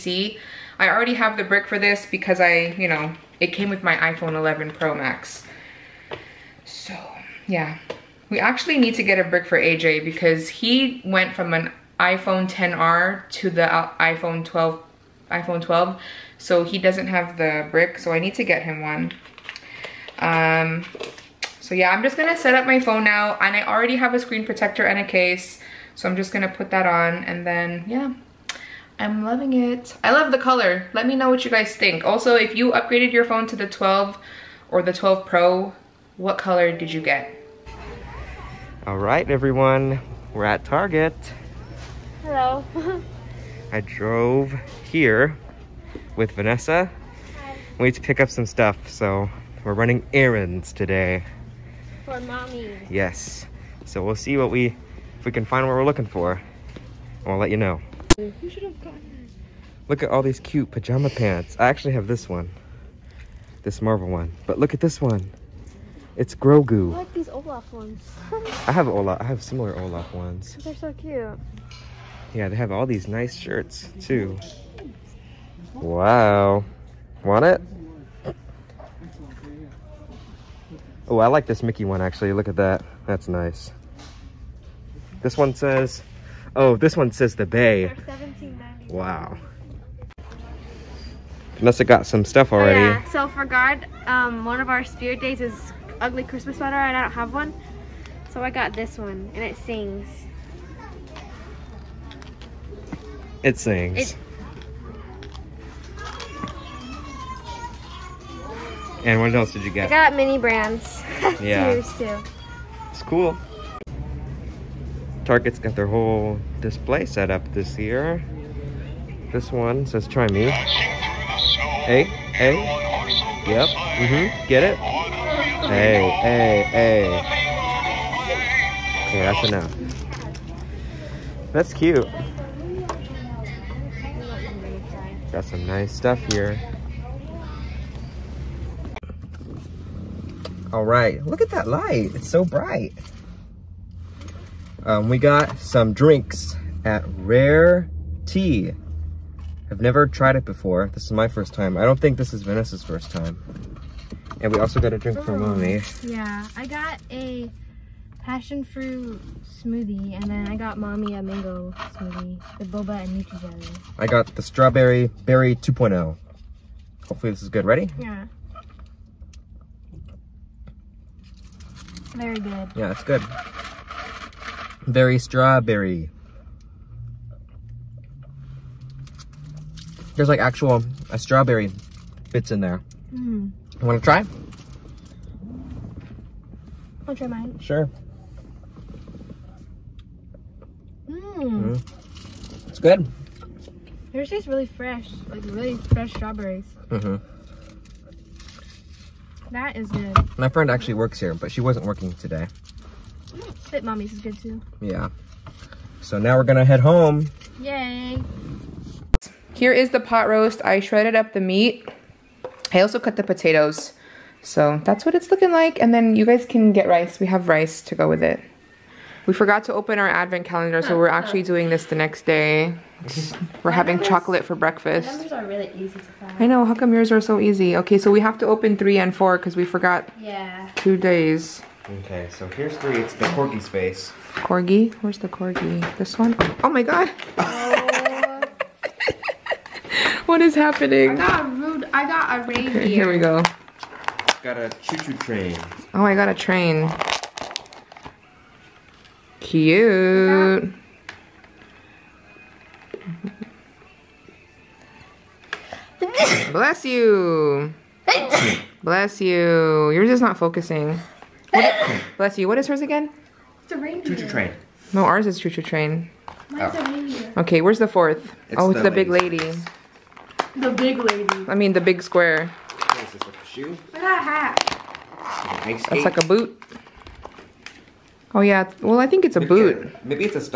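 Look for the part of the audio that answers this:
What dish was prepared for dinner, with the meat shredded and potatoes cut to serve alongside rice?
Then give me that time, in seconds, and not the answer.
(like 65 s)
209 s.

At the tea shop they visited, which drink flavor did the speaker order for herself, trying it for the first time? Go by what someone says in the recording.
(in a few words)
strawberry berry 2.0.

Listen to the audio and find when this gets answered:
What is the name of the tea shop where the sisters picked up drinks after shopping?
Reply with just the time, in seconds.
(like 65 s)
147 s.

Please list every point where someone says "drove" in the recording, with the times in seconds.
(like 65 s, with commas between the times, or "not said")
43 s.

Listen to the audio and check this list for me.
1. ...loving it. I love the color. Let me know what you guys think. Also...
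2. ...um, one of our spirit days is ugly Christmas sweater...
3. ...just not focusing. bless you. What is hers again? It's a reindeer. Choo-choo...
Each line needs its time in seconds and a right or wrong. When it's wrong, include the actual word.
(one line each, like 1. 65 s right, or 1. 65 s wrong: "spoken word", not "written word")
1. 29 s right
2. 94 s right
3. 260 s right.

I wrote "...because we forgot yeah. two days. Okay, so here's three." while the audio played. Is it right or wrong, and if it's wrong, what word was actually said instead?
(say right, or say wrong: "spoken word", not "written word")
right.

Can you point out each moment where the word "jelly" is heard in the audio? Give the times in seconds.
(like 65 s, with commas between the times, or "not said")
163 s.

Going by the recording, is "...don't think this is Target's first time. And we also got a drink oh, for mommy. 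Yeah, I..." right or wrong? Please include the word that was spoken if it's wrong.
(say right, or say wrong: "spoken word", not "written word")
wrong: "Vanessa", not "Target".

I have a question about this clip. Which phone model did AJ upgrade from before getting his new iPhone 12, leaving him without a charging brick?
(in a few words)
iPhone 10R.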